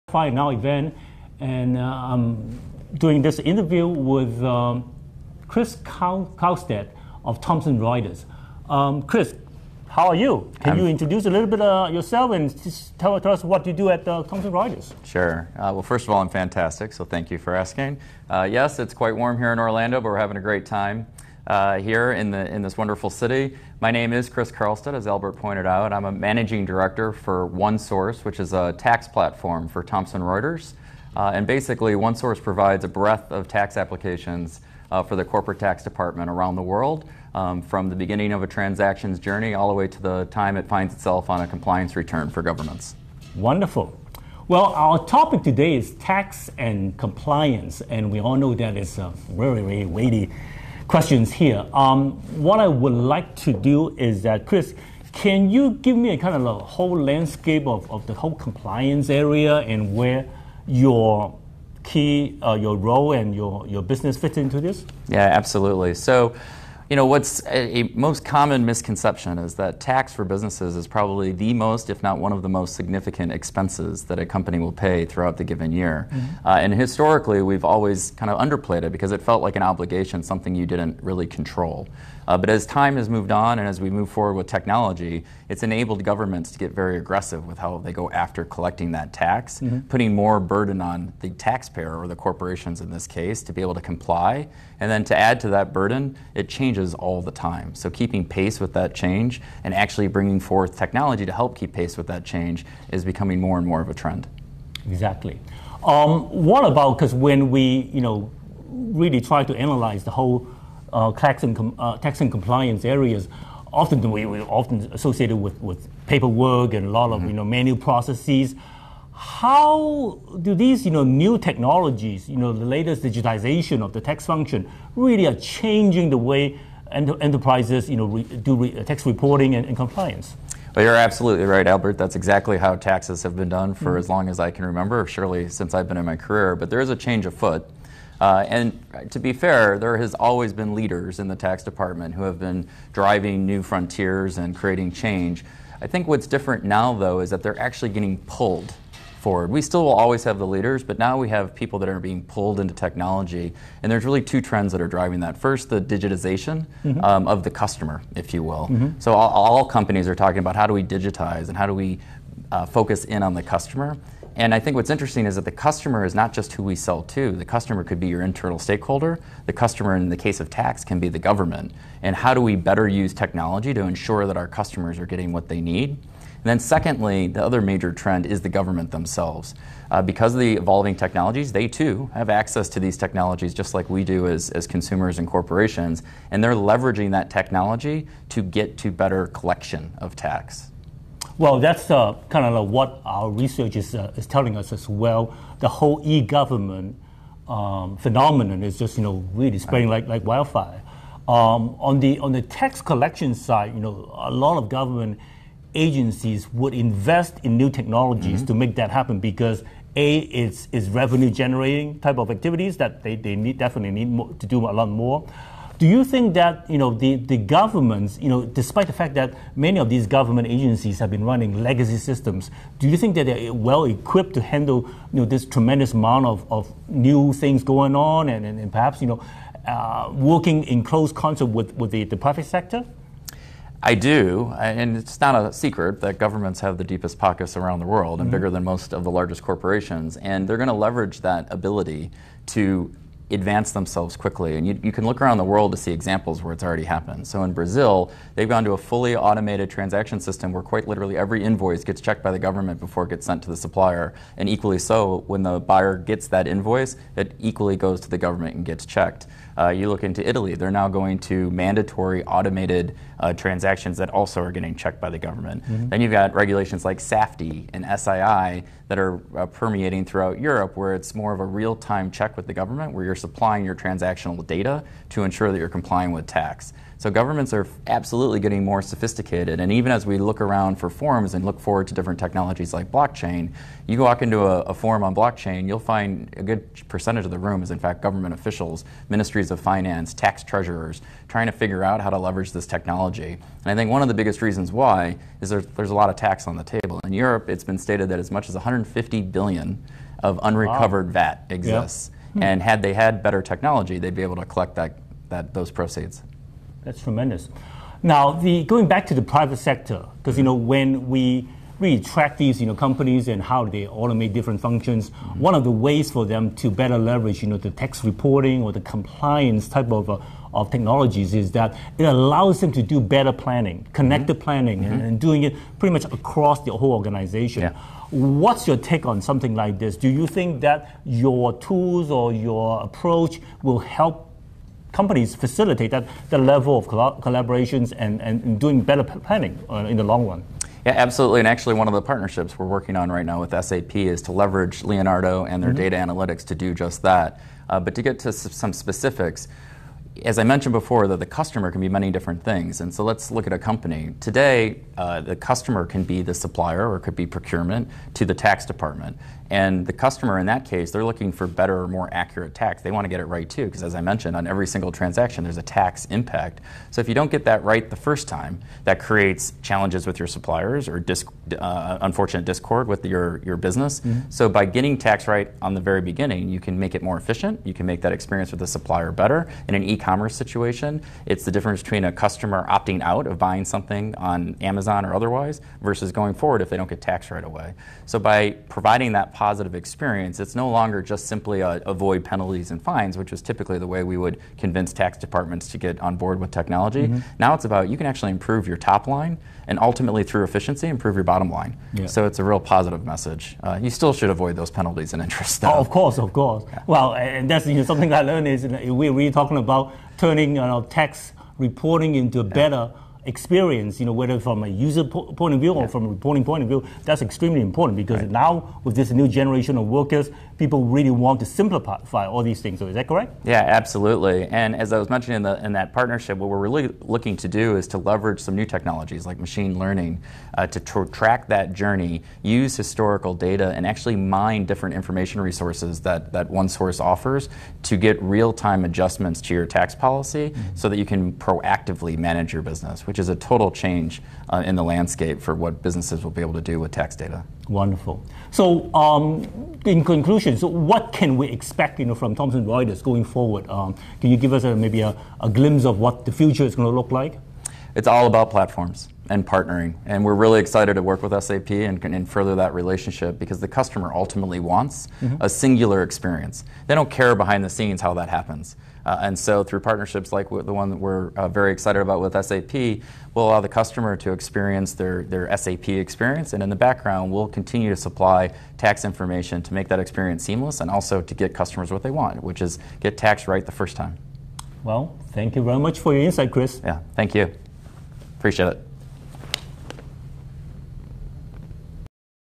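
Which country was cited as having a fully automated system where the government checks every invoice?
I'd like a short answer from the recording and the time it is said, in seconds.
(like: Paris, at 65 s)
Brazil, at 247 s.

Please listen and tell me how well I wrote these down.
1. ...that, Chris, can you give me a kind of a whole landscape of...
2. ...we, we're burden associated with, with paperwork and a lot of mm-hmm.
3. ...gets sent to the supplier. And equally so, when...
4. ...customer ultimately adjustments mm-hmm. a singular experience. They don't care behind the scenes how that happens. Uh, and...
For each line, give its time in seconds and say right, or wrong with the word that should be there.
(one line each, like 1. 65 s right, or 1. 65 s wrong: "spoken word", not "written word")
1. 54 s right
2. 114 s wrong: "often", not "burden"
3. 253 s right
4. 463 s wrong: "wants", not "adjustments".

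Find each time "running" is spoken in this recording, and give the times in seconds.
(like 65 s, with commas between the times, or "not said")
221 s.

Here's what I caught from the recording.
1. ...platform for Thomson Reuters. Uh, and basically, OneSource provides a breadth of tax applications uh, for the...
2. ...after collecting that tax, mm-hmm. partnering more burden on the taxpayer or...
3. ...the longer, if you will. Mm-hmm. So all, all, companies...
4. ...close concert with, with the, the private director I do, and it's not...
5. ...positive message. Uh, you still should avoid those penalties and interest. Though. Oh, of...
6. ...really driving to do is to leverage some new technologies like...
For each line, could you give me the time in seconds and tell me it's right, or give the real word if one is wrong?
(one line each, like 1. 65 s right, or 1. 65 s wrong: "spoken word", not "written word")
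1. 29 s right
2. 88 s wrong: "putting", not "partnering"
3. 157 s wrong: "customer", not "longer"
4. 230 s wrong: "sector", not "director"
5. 402 s right
6. 426 s wrong: "looking", not "driving".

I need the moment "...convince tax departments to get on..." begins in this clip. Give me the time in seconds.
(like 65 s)
394 s.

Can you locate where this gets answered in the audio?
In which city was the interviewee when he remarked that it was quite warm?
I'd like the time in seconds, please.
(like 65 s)
19 s.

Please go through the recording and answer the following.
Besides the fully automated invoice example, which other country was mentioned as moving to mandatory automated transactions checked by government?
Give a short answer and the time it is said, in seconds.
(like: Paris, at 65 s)
Italy, at 260 s.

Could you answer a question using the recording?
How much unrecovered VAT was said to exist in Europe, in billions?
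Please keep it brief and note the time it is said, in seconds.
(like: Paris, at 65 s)
150 billion, at 298 s.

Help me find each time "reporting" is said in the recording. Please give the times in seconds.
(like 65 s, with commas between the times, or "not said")
129 s, 318 s, 411 s, 416 s.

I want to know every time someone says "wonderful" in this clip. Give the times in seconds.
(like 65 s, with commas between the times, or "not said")
22 s, 43 s, 447 s.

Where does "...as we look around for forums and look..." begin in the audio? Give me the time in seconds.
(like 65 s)
279 s.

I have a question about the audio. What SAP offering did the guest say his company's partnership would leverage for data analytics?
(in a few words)
Leonardo.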